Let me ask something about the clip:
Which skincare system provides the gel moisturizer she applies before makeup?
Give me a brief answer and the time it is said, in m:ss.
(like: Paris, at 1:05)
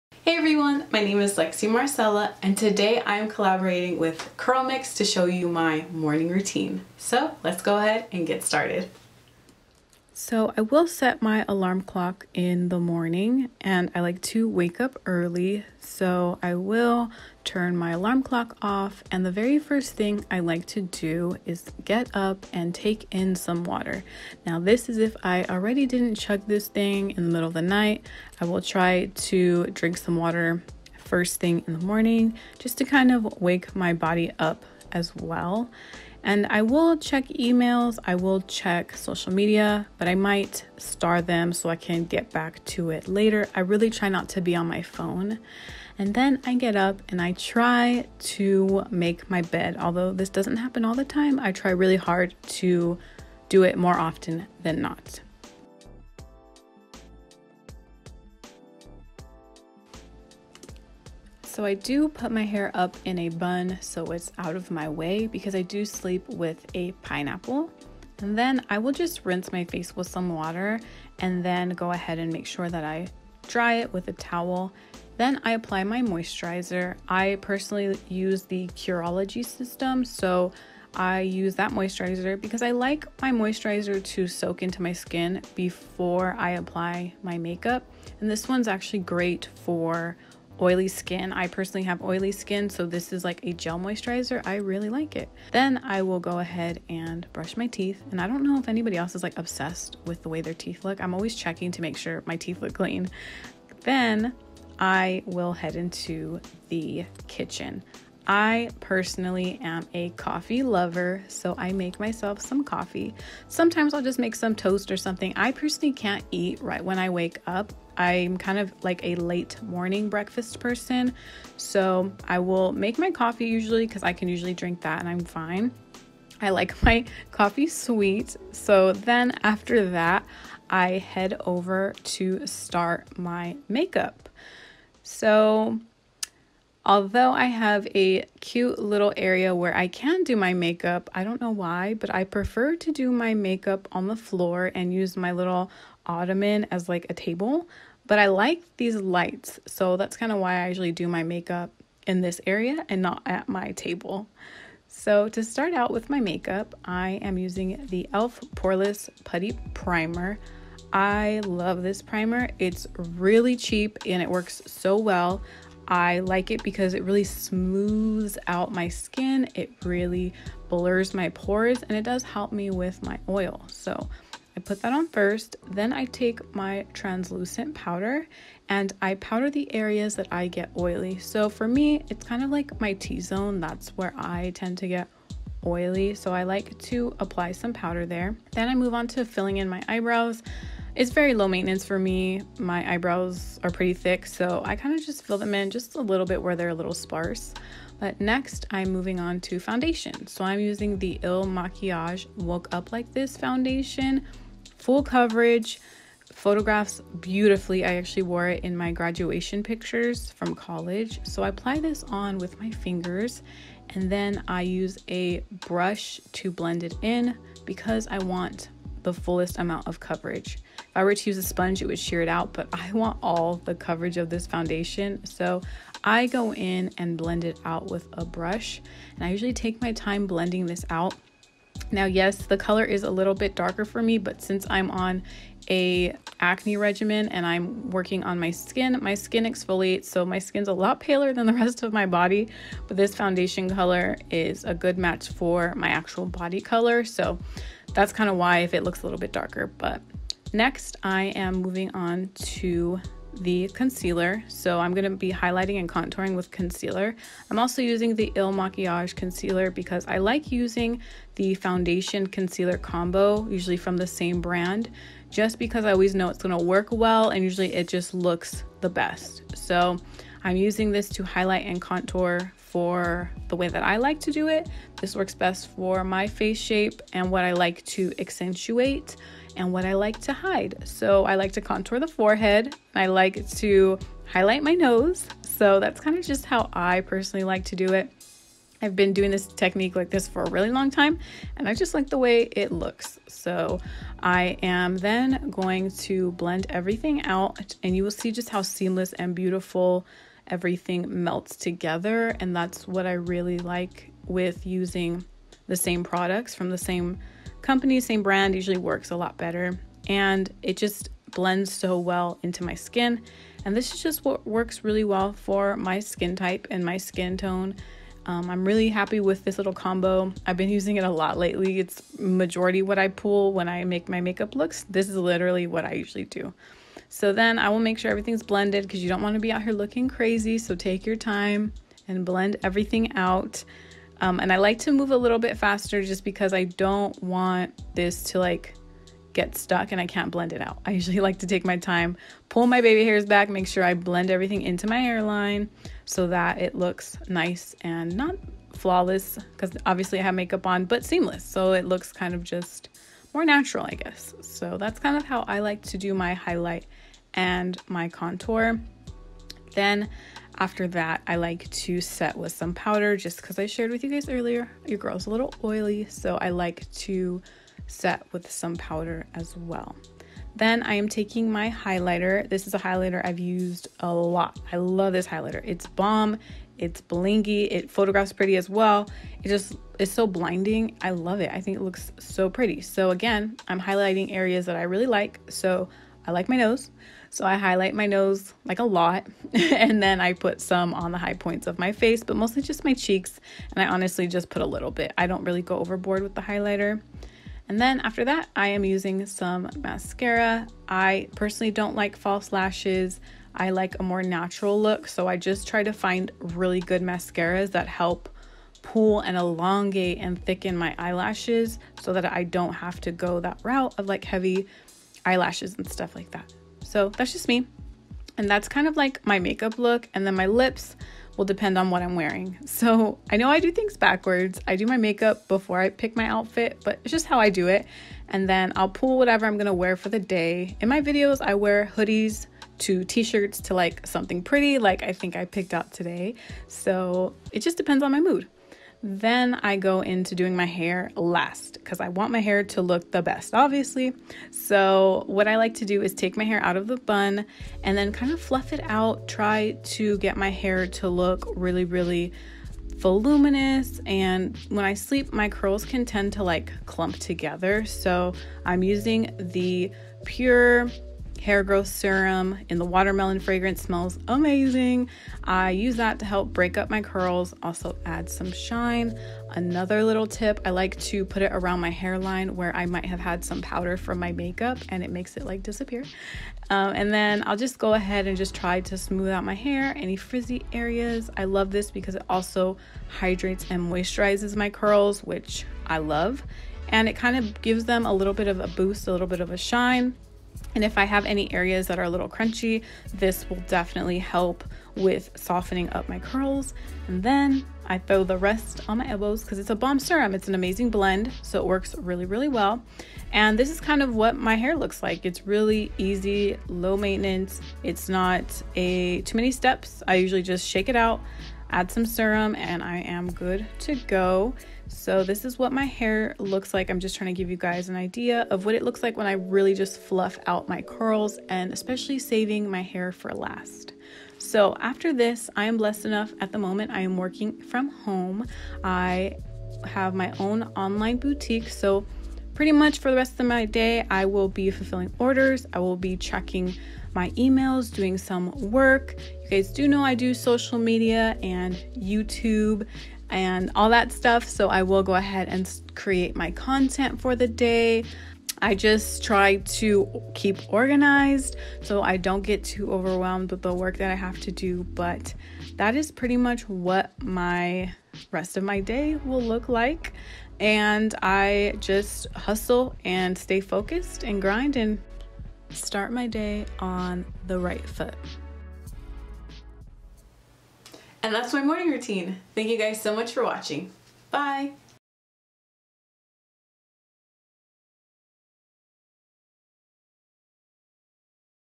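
Curology, at 1:18.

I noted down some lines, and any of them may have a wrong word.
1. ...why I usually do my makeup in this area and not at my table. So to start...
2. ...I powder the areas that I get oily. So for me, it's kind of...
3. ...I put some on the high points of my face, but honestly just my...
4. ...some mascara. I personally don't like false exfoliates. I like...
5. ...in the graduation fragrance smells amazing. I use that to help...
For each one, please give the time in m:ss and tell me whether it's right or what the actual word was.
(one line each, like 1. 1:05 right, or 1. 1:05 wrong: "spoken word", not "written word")
1. 2:30 right
2. 2:59 right
3. 6:30 wrong: "mostly", not "honestly"
4. 6:39 wrong: "lashes", not "exfoliates"
5. 7:42 wrong: "watermelon", not "graduation".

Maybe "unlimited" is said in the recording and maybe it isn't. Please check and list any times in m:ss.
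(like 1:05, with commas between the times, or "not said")
not said.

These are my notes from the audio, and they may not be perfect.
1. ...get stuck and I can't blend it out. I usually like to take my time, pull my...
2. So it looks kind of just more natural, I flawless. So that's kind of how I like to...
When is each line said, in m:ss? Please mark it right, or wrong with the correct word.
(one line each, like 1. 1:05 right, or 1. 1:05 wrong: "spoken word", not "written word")
1. 5:39 right
2. 5:51 wrong: "guess", not "flawless".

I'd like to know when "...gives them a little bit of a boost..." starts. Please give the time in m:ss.
8:07.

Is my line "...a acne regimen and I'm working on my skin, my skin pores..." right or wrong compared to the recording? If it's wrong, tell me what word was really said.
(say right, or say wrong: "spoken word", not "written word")
wrong: "exfoliates", not "pores".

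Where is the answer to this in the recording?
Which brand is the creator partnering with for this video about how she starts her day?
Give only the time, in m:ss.
0:04.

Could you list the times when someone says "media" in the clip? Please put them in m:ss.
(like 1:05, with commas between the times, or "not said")
0:39, 9:00.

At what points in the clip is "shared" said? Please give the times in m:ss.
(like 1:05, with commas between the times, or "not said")
6:03.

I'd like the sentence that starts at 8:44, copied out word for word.
So after this, I am blessed enough at the moment.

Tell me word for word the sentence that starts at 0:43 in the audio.
I really try not to be on my phone.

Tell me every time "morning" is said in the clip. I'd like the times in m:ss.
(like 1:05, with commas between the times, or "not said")
0:05, 0:12, 0:31, 1:59, 9:31.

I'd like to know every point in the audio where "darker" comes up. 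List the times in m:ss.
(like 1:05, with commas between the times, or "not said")
3:53, 4:09.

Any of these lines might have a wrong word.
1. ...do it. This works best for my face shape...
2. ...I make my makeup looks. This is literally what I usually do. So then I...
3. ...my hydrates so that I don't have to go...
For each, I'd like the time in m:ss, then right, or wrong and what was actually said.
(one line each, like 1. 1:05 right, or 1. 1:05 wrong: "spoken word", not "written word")
1. 4:34 right
2. 5:23 right
3. 6:50 wrong: "eyelashes", not "hydrates".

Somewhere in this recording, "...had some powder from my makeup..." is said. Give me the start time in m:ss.
7:53.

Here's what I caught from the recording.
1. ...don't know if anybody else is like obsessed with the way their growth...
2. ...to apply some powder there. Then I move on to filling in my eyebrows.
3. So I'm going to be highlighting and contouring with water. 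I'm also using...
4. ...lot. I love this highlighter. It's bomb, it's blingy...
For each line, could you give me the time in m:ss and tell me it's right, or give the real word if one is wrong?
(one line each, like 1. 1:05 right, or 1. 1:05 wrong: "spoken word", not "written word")
1. 1:38 wrong: "teeth", not "growth"
2. 3:06 right
3. 4:14 wrong: "concealer", not "water"
4. 6:14 right.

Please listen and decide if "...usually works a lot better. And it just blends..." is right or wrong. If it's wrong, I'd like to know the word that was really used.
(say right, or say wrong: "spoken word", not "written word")
right.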